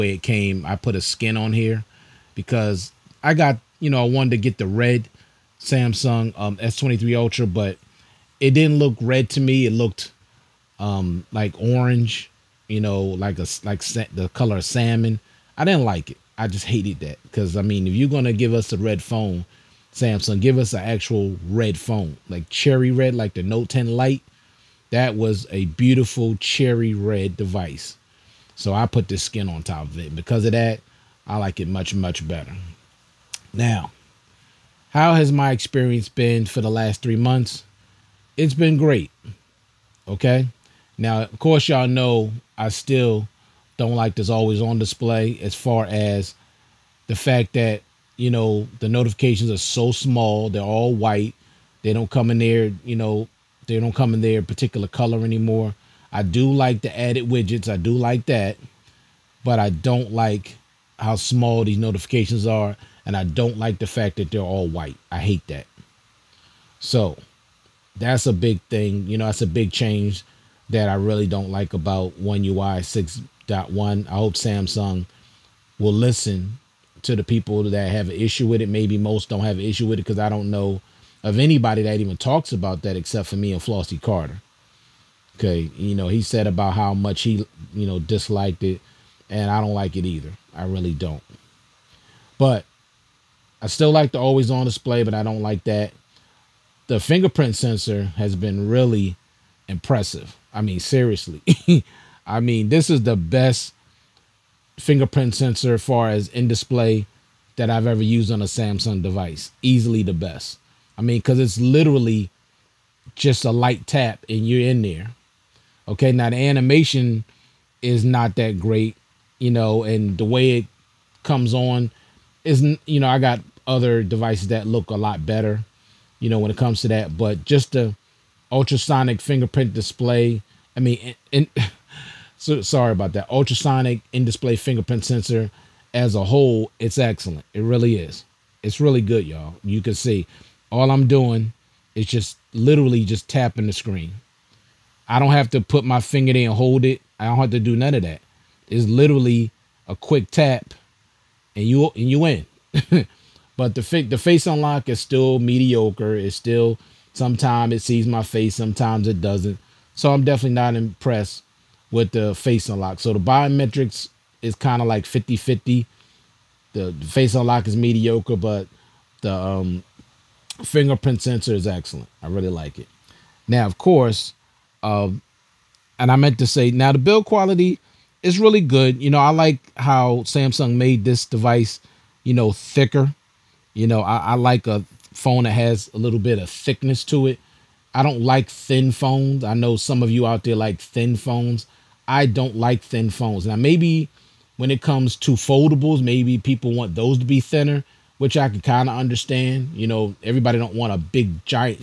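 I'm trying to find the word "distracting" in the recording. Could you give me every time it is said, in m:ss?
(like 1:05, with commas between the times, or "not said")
not said.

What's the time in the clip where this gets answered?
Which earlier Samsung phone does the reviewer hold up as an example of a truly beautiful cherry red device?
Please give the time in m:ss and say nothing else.
0:23.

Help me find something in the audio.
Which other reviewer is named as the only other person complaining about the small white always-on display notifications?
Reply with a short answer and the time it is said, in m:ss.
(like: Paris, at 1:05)
Flossy Carter, at 1:23.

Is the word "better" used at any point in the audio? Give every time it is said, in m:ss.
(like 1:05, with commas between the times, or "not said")
0:32, 2:05.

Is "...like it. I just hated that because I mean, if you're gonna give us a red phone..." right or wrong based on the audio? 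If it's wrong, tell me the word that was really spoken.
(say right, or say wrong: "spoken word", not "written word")
right.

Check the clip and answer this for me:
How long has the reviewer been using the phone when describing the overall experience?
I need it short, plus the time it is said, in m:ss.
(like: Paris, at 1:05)
3 months, at 0:37.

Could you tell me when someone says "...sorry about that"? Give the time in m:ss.
2:12.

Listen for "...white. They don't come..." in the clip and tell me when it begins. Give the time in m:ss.
0:50.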